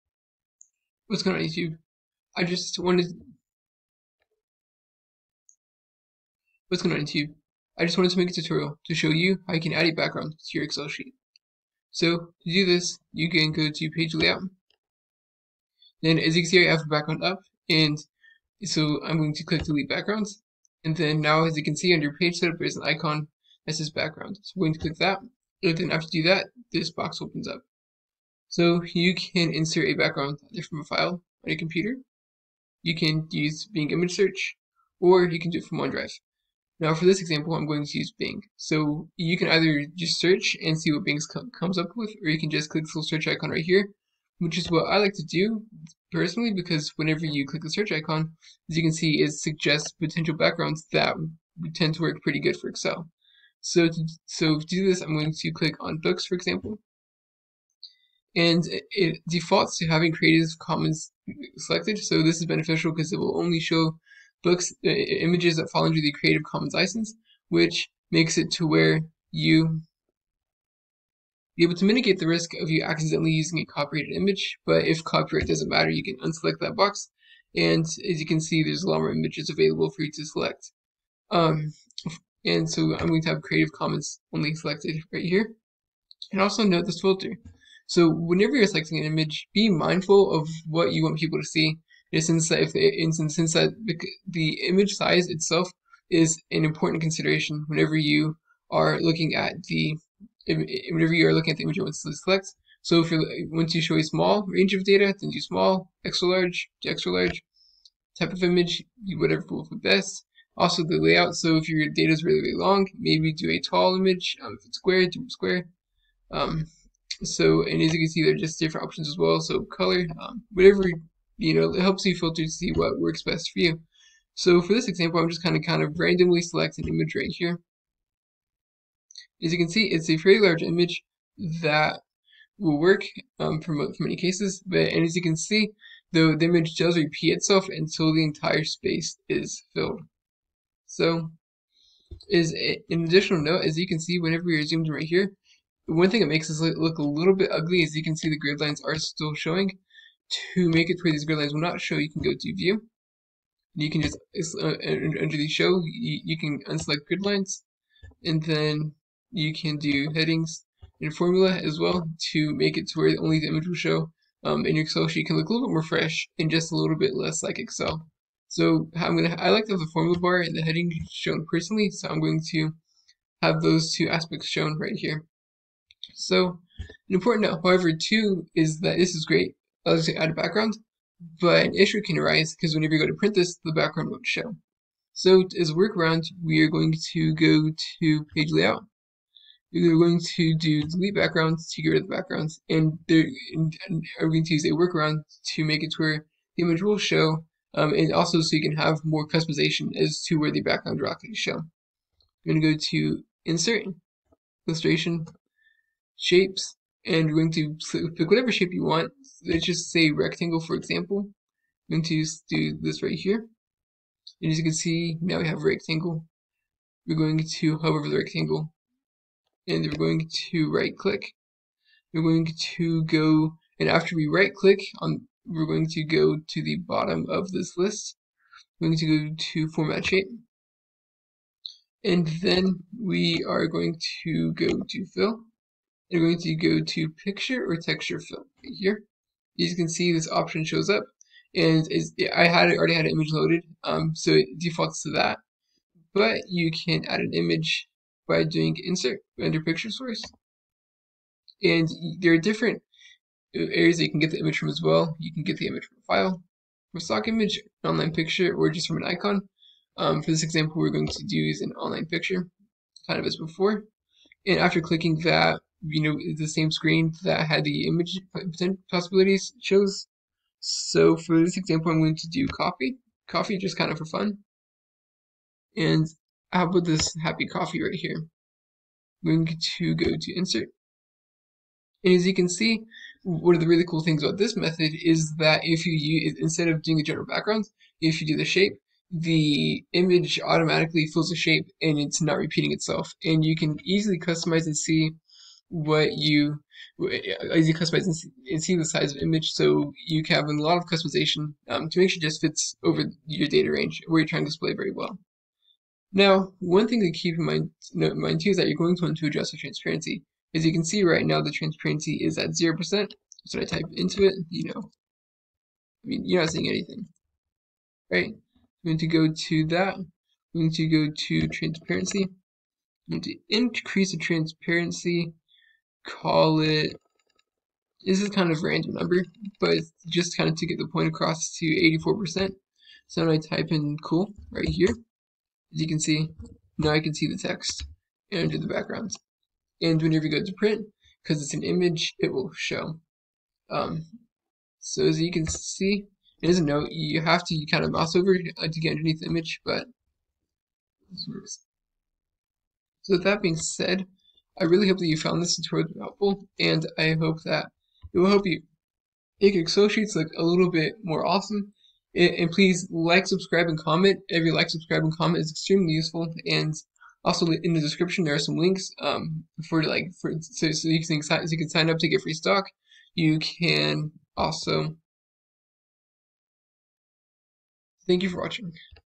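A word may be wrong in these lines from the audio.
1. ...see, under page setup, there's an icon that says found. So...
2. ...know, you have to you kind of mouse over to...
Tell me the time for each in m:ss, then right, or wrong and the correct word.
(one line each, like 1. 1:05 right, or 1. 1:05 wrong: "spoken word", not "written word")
1. 0:21 wrong: "background", not "found"
2. 5:46 right.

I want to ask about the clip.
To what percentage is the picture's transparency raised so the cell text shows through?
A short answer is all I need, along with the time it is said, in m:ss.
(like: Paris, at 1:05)
84%, at 5:32.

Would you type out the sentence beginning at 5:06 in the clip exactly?
Now, one thing to keep in mind, note in mind too is that you're going to want to adjust the transparency.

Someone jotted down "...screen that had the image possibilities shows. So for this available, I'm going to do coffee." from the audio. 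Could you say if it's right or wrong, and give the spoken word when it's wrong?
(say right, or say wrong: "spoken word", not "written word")
wrong: "example", not "available".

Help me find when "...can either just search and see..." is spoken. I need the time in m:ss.
0:39.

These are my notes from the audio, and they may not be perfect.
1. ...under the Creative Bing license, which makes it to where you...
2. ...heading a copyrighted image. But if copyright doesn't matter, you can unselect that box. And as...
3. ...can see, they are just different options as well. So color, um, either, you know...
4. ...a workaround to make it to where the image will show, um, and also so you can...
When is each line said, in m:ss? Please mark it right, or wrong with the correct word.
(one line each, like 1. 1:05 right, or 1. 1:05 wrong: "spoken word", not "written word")
1. 1:05 wrong: "Commons", not "Bing"
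2. 1:13 wrong: "using", not "heading"
3. 1:57 wrong: "whatever", not "either"
4. 3:14 right.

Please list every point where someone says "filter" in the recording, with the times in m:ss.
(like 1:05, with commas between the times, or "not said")
1:27, 2:02.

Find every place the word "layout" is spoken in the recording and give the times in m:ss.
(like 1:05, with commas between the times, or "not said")
0:14, 1:50, 3:08.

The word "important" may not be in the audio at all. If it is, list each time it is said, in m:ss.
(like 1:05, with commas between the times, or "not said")
1:36, 2:57.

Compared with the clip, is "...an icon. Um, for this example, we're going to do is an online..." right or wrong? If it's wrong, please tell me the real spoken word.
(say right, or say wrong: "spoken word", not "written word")
right.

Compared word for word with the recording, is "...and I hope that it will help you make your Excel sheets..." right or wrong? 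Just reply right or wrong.
right.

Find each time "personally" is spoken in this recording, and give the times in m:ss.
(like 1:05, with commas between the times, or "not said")
0:46, 2:51.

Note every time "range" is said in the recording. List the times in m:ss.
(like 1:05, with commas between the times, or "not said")
1:44, 5:03.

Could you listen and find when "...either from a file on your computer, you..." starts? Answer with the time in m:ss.
0:30.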